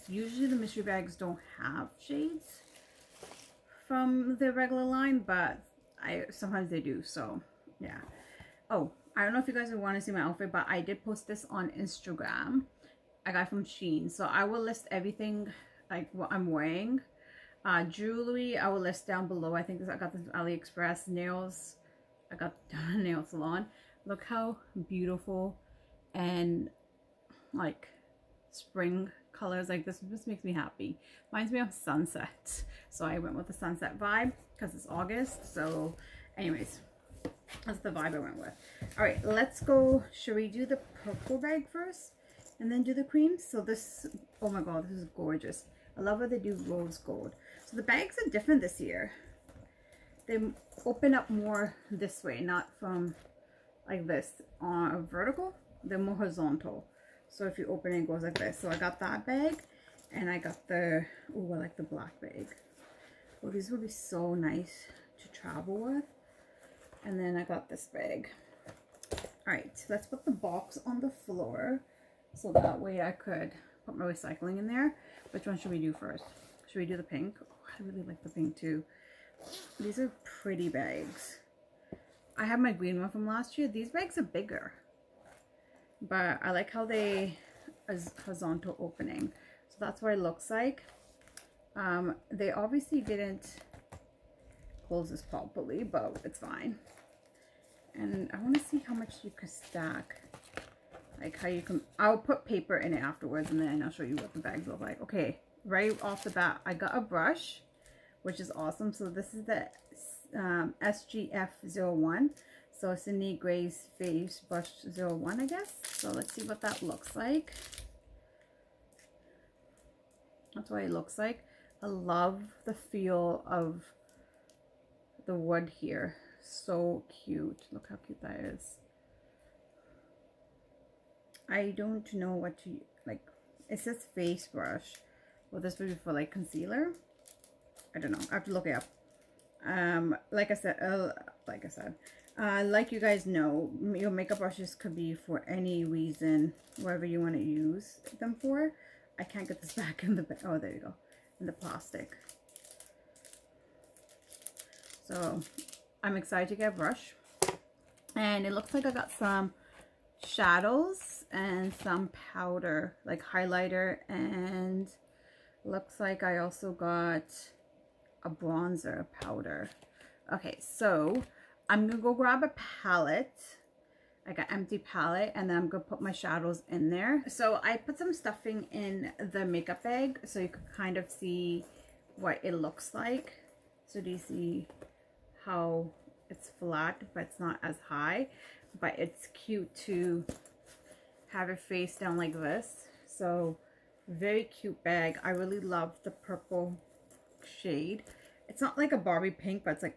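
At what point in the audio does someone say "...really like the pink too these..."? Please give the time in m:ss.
1:17.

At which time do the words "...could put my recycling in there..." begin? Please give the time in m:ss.
1:13.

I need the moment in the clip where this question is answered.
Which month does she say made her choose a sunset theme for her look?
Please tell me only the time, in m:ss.
0:34.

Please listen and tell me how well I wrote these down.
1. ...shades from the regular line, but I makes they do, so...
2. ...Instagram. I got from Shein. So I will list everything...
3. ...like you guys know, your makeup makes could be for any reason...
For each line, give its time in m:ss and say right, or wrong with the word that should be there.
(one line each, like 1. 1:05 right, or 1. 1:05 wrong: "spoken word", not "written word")
1. 0:01 wrong: "sometimes", not "makes"
2. 0:11 right
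3. 2:22 wrong: "brushes", not "makes".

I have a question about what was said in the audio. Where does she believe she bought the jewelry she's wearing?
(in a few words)
AliExpress.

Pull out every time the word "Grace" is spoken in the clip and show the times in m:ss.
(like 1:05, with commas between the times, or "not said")
1:53.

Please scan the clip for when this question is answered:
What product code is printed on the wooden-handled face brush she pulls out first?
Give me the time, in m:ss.
1:50.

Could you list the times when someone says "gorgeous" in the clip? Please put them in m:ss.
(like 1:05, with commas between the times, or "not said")
0:45.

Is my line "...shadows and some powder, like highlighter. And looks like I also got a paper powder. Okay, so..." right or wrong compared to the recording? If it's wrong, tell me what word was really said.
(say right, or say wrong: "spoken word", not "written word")
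wrong: "bronzer", not "paper".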